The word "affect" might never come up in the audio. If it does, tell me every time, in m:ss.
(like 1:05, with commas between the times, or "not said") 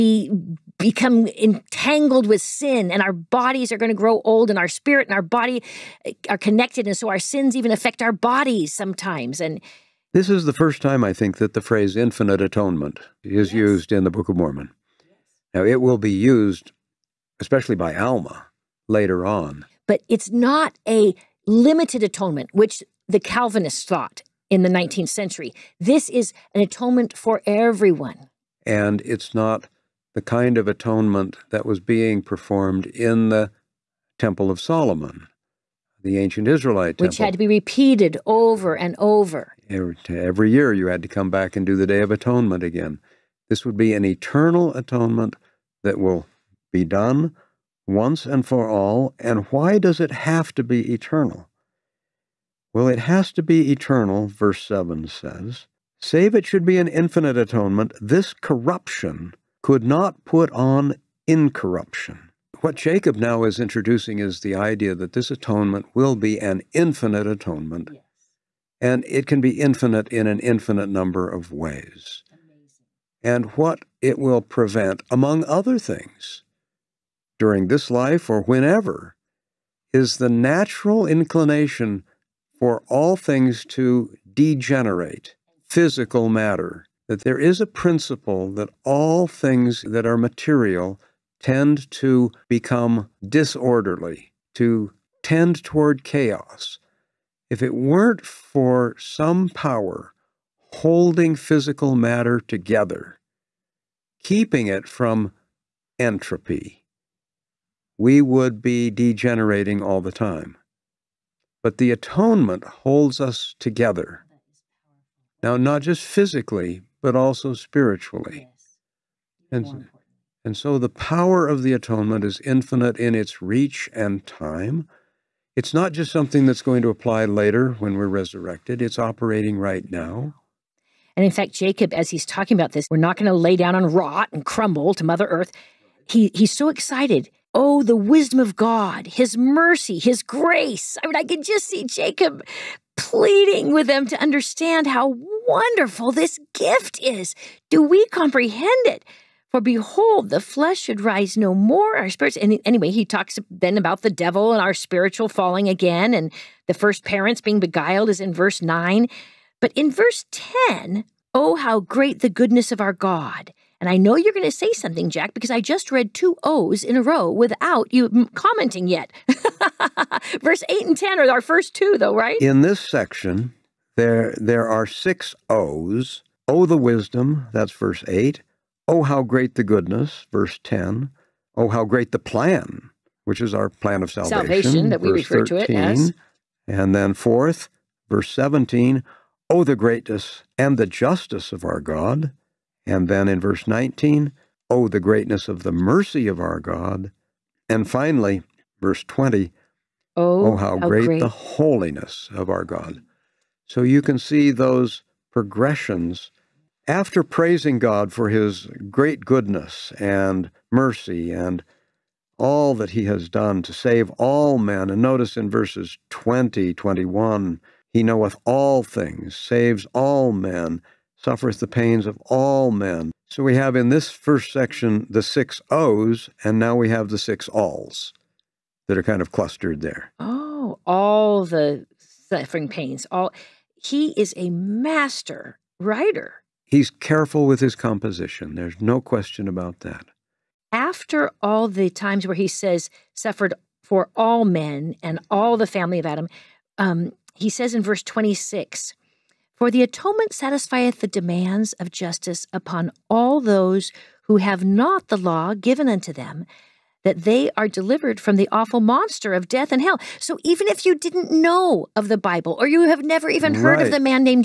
0:07.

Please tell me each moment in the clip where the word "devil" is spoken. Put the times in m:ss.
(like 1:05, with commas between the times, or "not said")
2:34.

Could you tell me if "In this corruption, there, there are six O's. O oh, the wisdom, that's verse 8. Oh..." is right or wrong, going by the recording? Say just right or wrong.
wrong.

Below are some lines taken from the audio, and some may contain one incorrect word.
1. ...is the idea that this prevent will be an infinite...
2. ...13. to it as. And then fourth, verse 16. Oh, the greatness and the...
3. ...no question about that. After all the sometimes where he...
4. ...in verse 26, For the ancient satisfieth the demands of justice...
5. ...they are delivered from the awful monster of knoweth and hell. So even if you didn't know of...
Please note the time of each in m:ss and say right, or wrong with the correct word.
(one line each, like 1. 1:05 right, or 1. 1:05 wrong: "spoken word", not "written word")
1. 1:04 wrong: "atonement", not "prevent"
2. 3:05 wrong: "17", not "16"
3. 3:58 wrong: "times", not "sometimes"
4. 4:07 wrong: "atonement", not "ancient"
5. 4:17 wrong: "death", not "knoweth".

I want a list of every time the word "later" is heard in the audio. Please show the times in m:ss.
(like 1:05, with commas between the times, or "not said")
0:18, 2:07.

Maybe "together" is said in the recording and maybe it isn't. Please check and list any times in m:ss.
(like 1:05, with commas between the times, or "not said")
1:42, 1:53.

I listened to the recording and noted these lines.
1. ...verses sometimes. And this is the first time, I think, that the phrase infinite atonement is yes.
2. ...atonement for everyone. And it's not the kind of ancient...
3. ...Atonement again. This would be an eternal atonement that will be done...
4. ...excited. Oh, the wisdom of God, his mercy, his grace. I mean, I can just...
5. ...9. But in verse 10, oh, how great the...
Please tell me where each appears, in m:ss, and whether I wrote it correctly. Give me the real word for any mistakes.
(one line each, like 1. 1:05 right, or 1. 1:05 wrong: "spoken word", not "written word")
1. 0:08 wrong: "bodies", not "verses"
2. 0:26 wrong: "atonement", not "ancient"
3. 0:42 right
4. 2:16 right
5. 2:38 right.